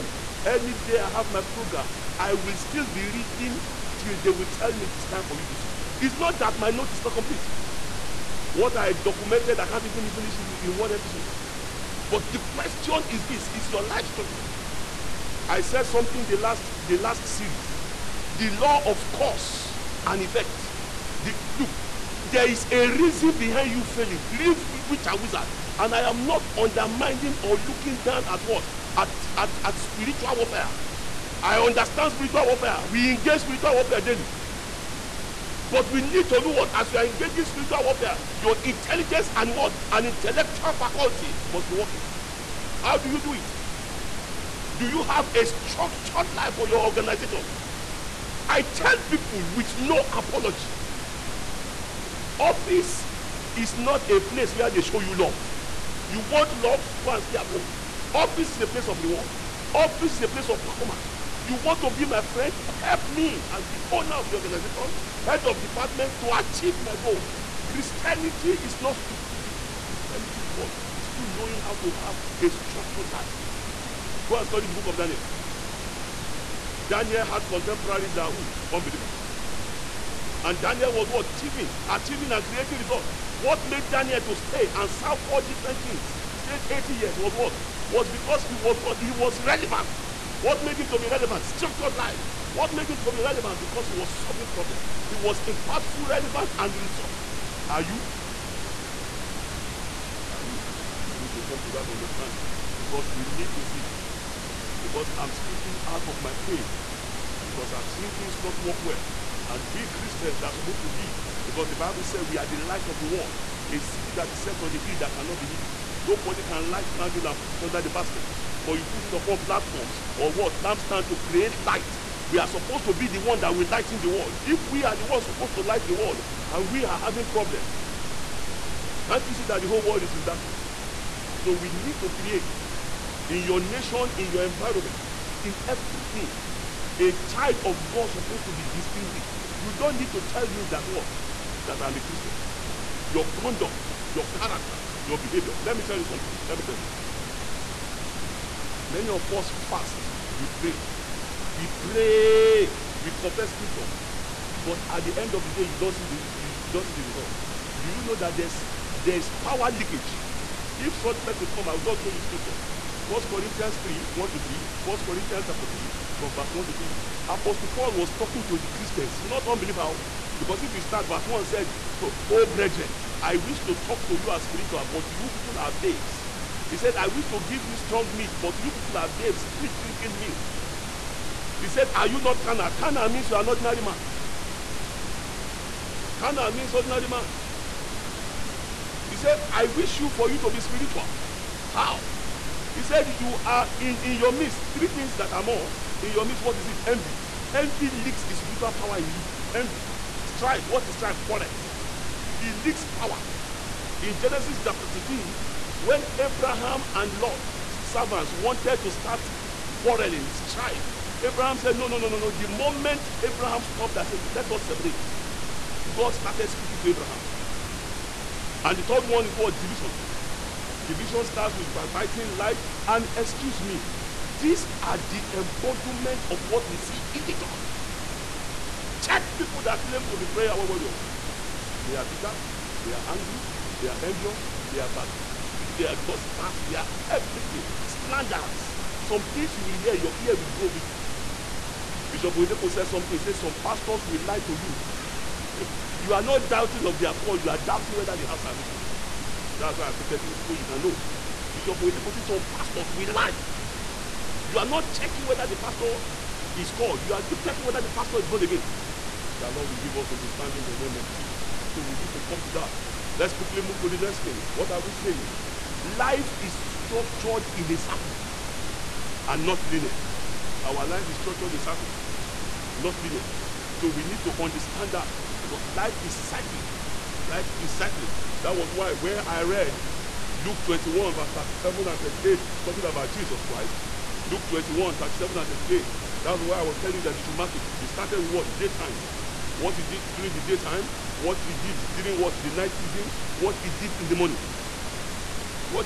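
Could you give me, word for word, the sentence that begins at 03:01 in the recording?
He said, Are you not carnal?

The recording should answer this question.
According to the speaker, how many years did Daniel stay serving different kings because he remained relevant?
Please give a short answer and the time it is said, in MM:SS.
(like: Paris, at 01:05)
80 years, at 01:26.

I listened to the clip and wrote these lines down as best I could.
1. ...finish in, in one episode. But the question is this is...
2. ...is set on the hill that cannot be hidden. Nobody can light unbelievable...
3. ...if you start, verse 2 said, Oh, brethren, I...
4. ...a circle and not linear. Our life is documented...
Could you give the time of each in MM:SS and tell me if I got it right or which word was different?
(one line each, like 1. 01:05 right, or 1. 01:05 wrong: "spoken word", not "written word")
1. 00:10 right
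2. 01:54 wrong: "candle", not "unbelievable"
3. 02:50 wrong: "1", not "2"
4. 04:27 wrong: "structured", not "documented".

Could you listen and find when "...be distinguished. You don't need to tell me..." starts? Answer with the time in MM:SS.
02:18.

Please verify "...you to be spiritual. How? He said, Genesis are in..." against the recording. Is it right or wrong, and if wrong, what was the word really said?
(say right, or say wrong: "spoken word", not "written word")
wrong: "You", not "Genesis".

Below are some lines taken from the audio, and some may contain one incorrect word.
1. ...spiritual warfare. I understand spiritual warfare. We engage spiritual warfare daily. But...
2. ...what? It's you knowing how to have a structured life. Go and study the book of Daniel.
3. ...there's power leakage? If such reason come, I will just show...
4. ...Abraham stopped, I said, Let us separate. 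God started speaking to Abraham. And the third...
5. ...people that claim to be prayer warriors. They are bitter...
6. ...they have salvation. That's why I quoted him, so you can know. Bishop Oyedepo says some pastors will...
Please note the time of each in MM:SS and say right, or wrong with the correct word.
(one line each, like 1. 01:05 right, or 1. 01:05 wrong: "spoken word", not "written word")
1. 00:29 right
2. 01:10 right
3. 02:38 wrong: "person", not "reason"
4. 03:33 right
5. 03:49 right
6. 04:08 right.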